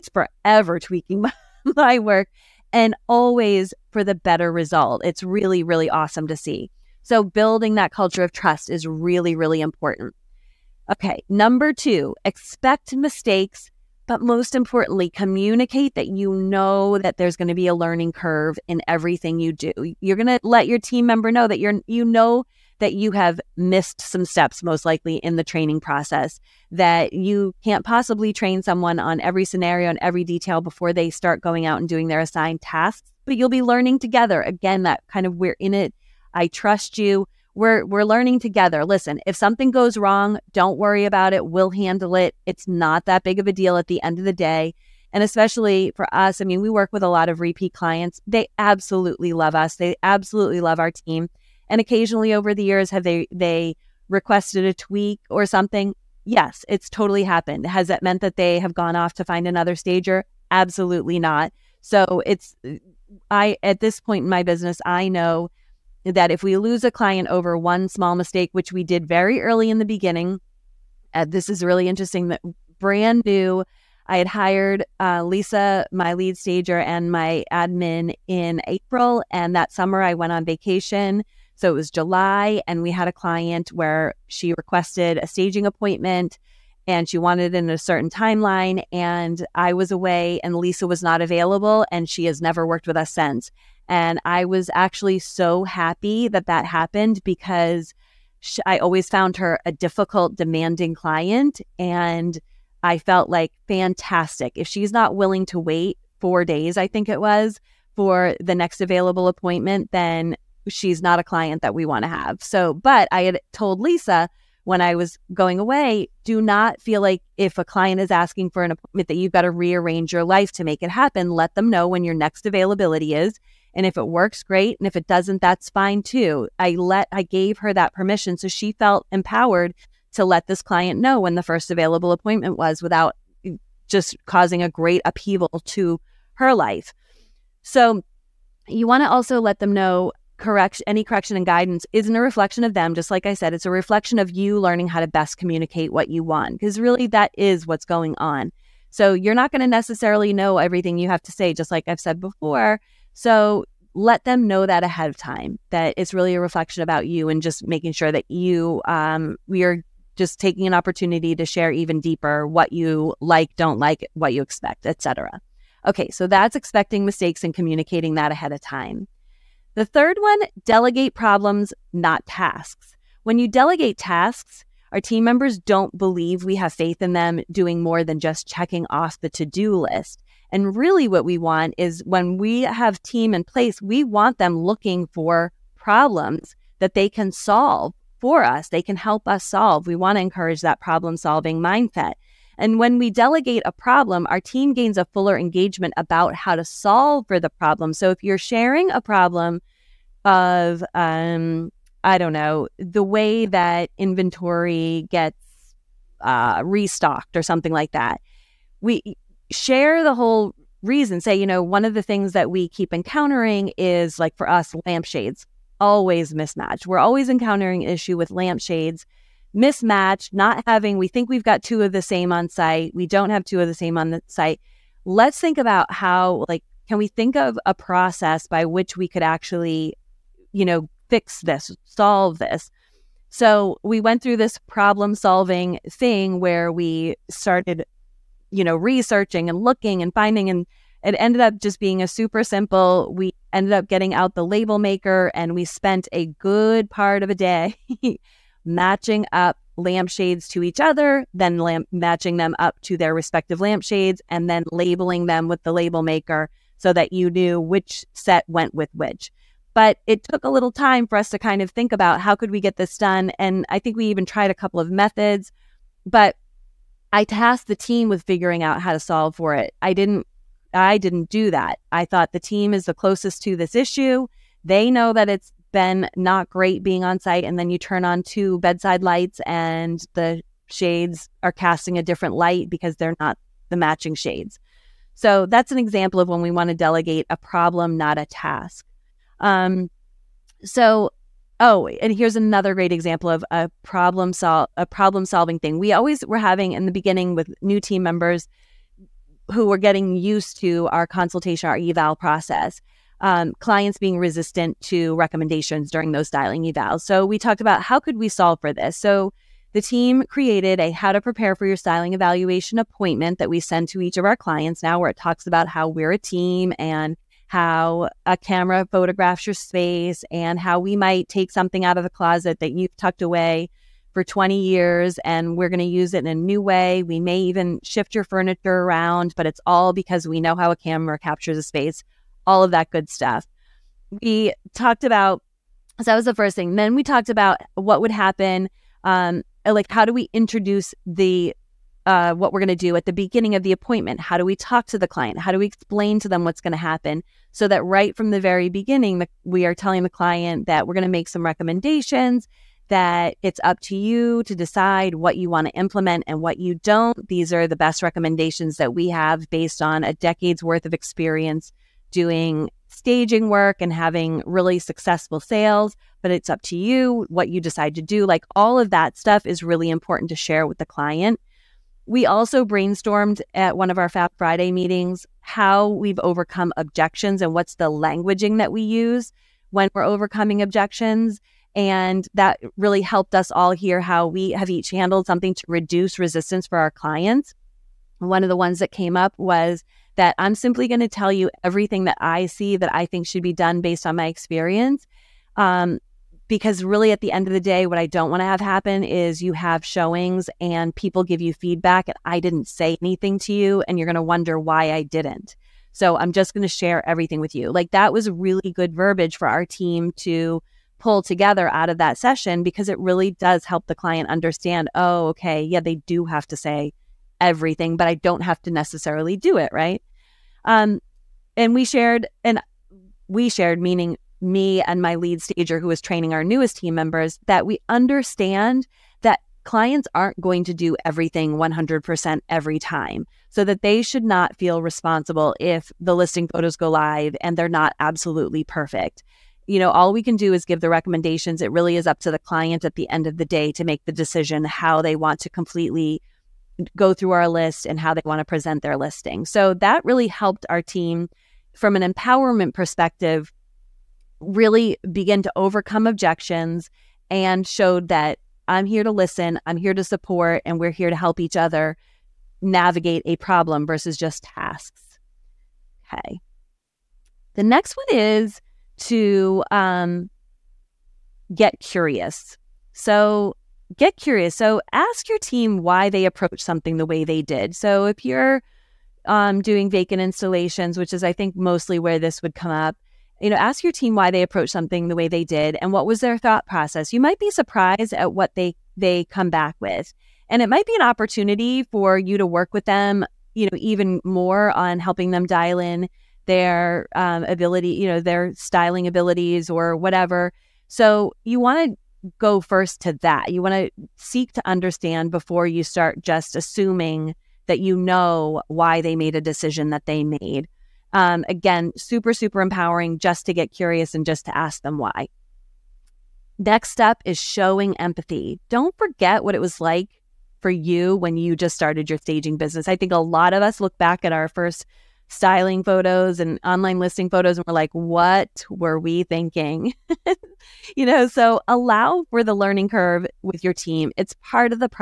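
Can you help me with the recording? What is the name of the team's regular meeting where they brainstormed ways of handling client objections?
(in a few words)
Fab Friday.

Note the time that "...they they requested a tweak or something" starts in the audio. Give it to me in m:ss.
0:53.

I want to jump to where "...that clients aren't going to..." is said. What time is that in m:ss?
7:09.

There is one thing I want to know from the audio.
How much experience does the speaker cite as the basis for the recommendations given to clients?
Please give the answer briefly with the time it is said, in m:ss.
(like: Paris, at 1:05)
A decade, at 6:00.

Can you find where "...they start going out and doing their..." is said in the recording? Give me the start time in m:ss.
0:30.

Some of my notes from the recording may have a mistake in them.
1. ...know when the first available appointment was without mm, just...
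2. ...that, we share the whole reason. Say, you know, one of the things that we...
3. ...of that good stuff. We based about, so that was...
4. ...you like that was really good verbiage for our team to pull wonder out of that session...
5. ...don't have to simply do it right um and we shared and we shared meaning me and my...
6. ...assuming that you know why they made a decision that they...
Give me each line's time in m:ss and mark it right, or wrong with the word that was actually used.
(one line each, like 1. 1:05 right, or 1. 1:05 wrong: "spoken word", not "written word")
1. 2:11 right
2. 3:27 right
3. 5:32 wrong: "talked", not "based"
4. 6:47 wrong: "together", not "wonder"
5. 6:58 wrong: "necessarily", not "simply"
6. 8:26 right.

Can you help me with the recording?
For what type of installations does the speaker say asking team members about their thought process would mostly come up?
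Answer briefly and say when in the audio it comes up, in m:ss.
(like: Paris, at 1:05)
Vacant installations, at 7:59.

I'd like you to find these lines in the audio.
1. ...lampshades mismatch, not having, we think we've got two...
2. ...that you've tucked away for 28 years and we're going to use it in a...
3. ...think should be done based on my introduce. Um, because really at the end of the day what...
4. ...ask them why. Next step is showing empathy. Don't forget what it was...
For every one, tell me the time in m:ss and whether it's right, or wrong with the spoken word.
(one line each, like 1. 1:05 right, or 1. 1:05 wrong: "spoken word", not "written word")
1. 3:38 right
2. 5:22 wrong: "20", not "28"
3. 6:33 wrong: "experience", not "introduce"
4. 8:34 right.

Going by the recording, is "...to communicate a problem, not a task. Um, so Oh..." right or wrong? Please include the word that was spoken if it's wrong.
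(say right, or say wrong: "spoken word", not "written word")
wrong: "delegate", not "communicate".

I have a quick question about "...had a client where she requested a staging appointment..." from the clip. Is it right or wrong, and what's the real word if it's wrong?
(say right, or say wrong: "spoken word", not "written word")
right.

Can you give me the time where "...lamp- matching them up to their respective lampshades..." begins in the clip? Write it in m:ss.
4:11.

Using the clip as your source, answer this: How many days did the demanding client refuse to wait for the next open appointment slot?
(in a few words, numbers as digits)
4.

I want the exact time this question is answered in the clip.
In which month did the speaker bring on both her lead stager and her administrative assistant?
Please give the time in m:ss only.
1:18.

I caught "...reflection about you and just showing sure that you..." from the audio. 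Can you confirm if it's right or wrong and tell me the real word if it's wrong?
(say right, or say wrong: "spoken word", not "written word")
wrong: "making", not "showing".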